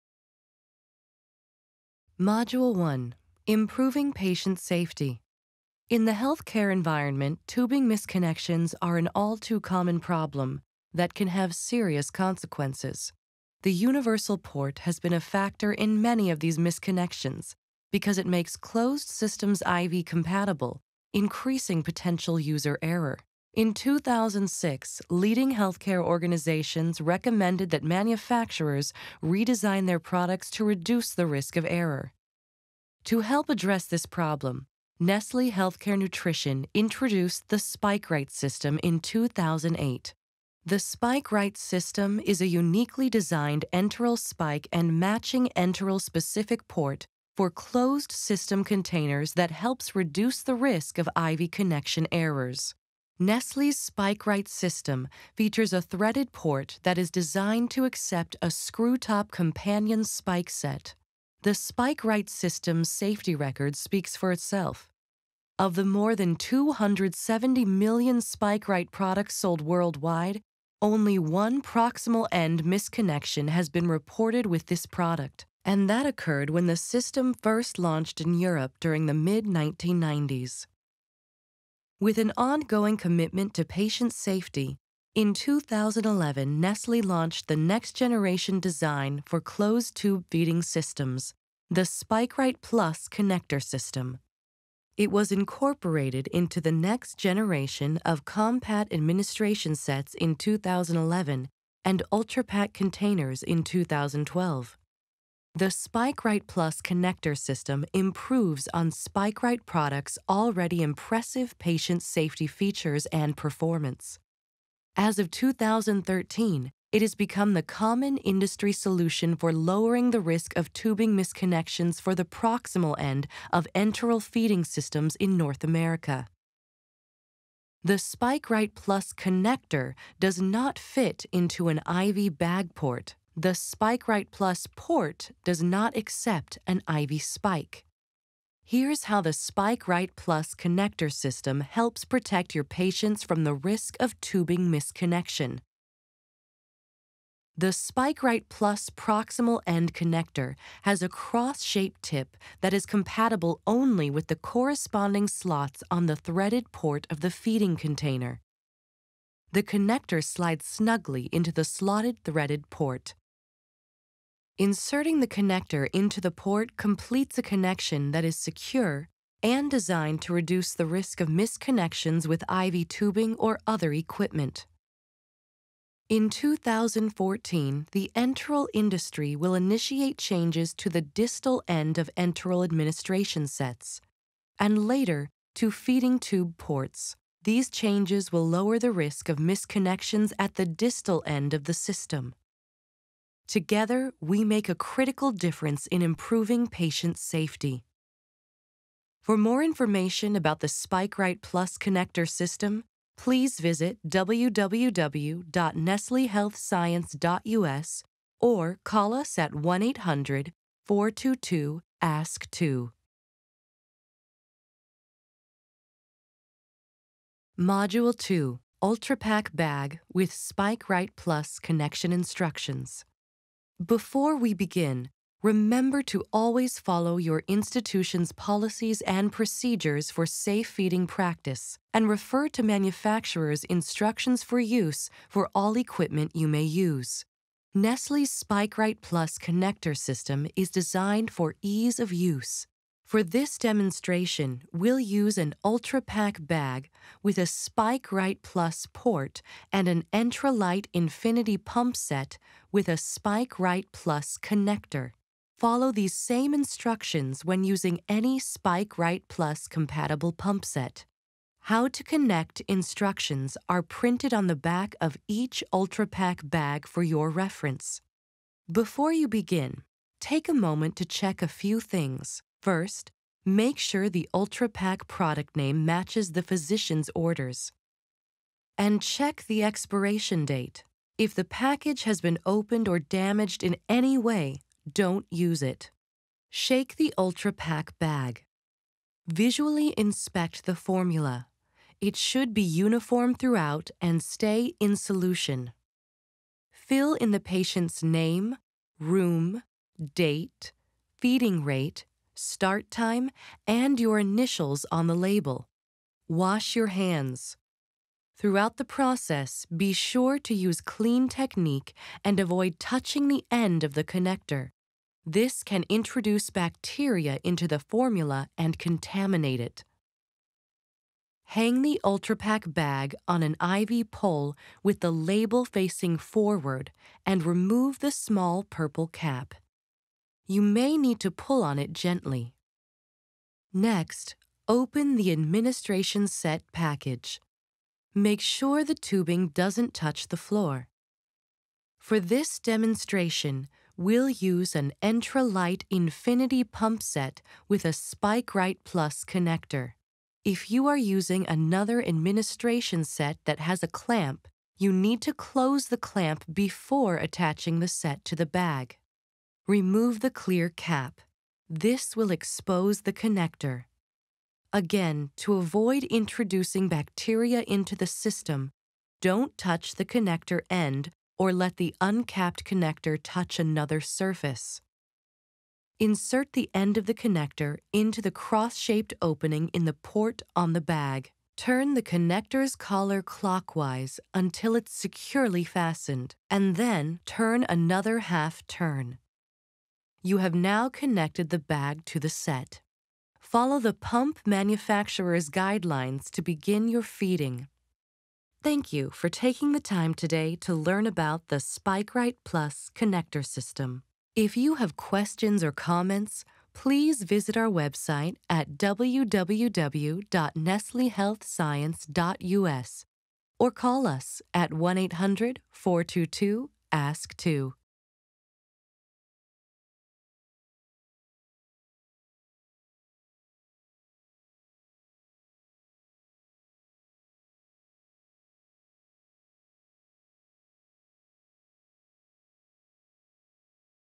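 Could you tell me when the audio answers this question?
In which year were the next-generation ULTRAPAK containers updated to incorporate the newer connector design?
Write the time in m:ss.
1:43.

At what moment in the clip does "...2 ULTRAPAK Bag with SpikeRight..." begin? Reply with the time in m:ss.
3:38.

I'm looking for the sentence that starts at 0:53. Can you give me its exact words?
Nestle's Right system features a threaded port that is designed to accept a screw-top companion spike set.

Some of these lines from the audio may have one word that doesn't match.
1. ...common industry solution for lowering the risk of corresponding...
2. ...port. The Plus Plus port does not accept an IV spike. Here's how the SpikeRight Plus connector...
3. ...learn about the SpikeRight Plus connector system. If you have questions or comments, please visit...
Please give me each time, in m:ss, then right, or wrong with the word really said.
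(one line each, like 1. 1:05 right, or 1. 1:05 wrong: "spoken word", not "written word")
1. 1:57 wrong: "tubing", not "corresponding"
2. 2:12 wrong: "SpikeRight", not "Plus"
3. 6:40 right.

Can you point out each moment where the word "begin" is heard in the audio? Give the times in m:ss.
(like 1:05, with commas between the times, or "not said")
3:44, 4:29, 6:36.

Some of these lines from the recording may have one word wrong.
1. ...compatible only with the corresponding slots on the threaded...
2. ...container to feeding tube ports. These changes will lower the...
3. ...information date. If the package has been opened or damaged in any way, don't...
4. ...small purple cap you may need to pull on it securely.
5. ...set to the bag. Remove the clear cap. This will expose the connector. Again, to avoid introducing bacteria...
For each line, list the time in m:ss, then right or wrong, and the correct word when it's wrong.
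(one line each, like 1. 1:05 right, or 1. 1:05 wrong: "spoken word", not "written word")
1. 2:32 right
2. 3:04 wrong: "later", not "container"
3. 4:39 wrong: "expiration", not "information"
4. 5:28 wrong: "gently", not "securely"
5. 5:57 right.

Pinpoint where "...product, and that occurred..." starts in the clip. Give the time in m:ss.
1:14.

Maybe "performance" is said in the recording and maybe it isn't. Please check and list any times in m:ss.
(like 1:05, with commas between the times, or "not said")
1:53.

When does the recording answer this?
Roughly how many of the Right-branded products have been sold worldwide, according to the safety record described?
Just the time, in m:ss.
1:06.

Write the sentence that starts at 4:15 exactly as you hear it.
Follow these same instructions when using any Spike Right Plus compatible pump set.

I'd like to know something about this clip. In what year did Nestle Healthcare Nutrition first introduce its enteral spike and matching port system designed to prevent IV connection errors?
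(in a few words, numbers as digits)
2008.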